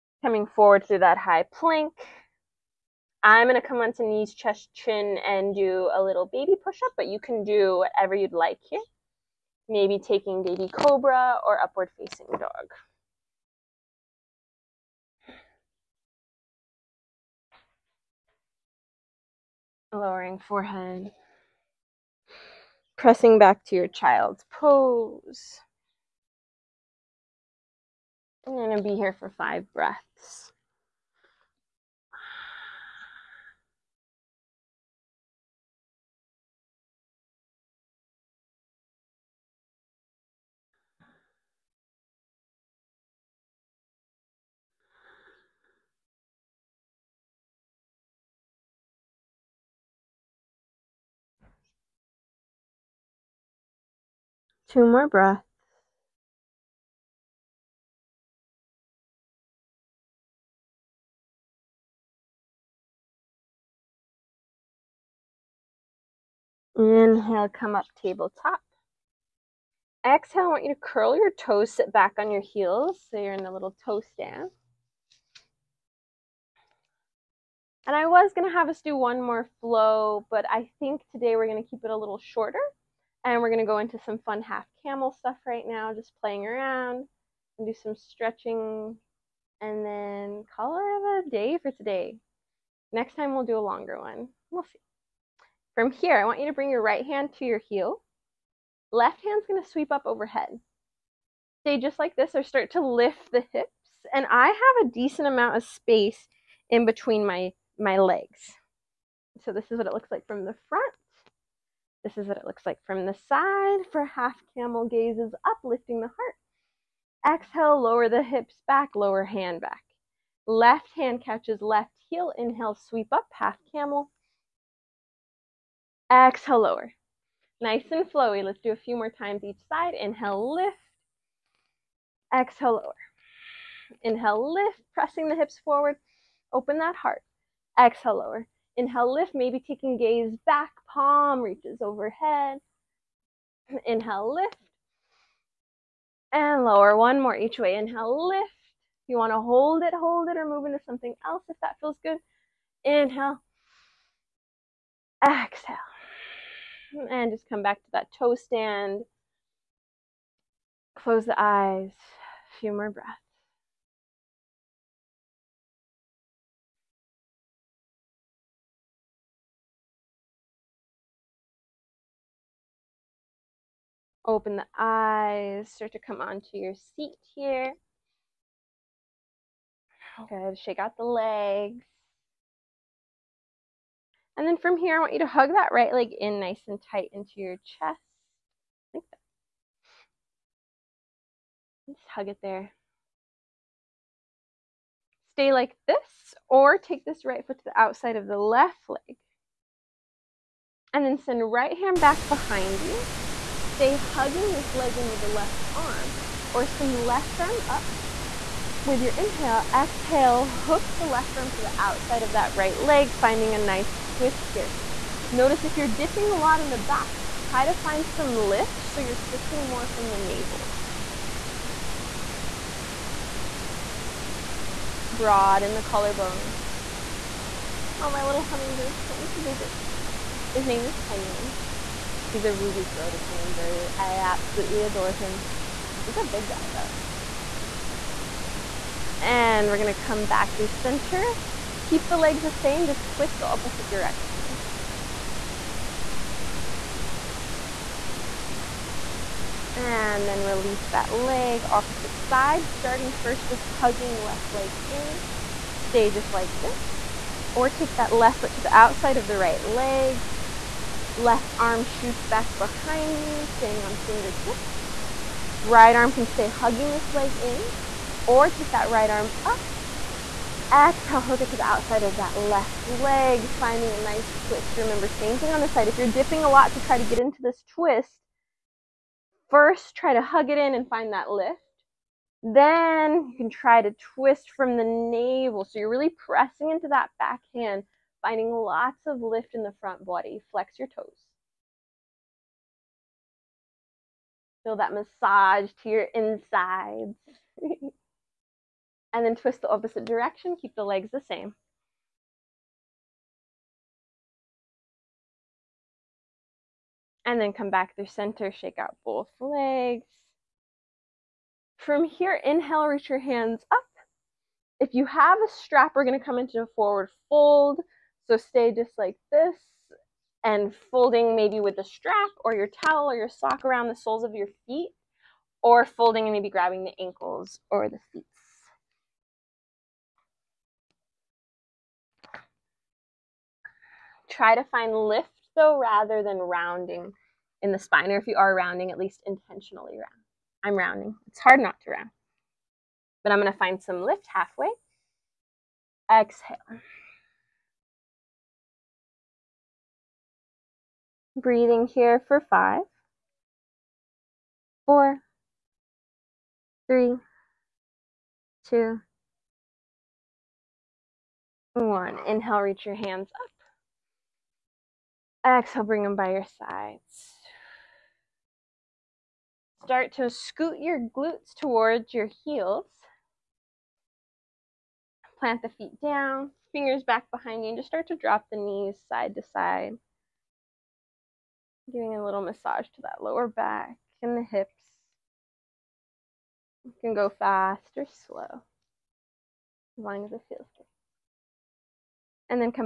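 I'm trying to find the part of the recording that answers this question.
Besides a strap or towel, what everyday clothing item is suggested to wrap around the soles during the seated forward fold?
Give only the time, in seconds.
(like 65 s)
323 s.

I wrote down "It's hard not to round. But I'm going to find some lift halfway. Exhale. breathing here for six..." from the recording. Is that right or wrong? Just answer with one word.
wrong.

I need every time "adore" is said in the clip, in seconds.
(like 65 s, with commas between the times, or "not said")
234 s.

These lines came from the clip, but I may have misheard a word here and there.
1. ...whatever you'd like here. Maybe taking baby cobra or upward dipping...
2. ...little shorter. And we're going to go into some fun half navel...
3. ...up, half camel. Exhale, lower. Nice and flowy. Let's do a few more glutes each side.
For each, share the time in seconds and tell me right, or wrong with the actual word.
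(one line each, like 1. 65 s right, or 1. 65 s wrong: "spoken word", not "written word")
1. 7 s wrong: "facing", not "dipping"
2. 81 s wrong: "camel", not "navel"
3. 123 s wrong: "times", not "glutes".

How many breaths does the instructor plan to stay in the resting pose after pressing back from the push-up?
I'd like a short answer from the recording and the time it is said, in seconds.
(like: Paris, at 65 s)
5, at 29 s.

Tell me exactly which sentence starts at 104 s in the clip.
And I have a decent amount of space in between my, my legs.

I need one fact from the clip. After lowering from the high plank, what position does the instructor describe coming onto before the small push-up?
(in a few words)
Knees, chest, chin.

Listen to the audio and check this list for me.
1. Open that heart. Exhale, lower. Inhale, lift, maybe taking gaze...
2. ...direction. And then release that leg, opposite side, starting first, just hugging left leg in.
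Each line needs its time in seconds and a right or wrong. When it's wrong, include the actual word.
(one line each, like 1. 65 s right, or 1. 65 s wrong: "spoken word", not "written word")
1. 136 s right
2. 243 s right.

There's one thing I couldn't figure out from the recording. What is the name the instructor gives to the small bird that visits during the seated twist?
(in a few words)
Henry.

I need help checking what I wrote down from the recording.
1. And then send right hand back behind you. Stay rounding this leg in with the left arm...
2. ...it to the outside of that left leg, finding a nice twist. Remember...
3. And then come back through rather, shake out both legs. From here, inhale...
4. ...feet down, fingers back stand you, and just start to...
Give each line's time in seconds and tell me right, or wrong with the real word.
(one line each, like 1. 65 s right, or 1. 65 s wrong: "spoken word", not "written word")
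1. 200 s wrong: "hugging", not "rounding"
2. 271 s right
3. 307 s wrong: "center", not "rather"
4. 375 s wrong: "behind", not "stand".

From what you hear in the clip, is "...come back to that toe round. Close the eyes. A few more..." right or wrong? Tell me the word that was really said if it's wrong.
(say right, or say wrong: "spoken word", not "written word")
wrong: "stand", not "round".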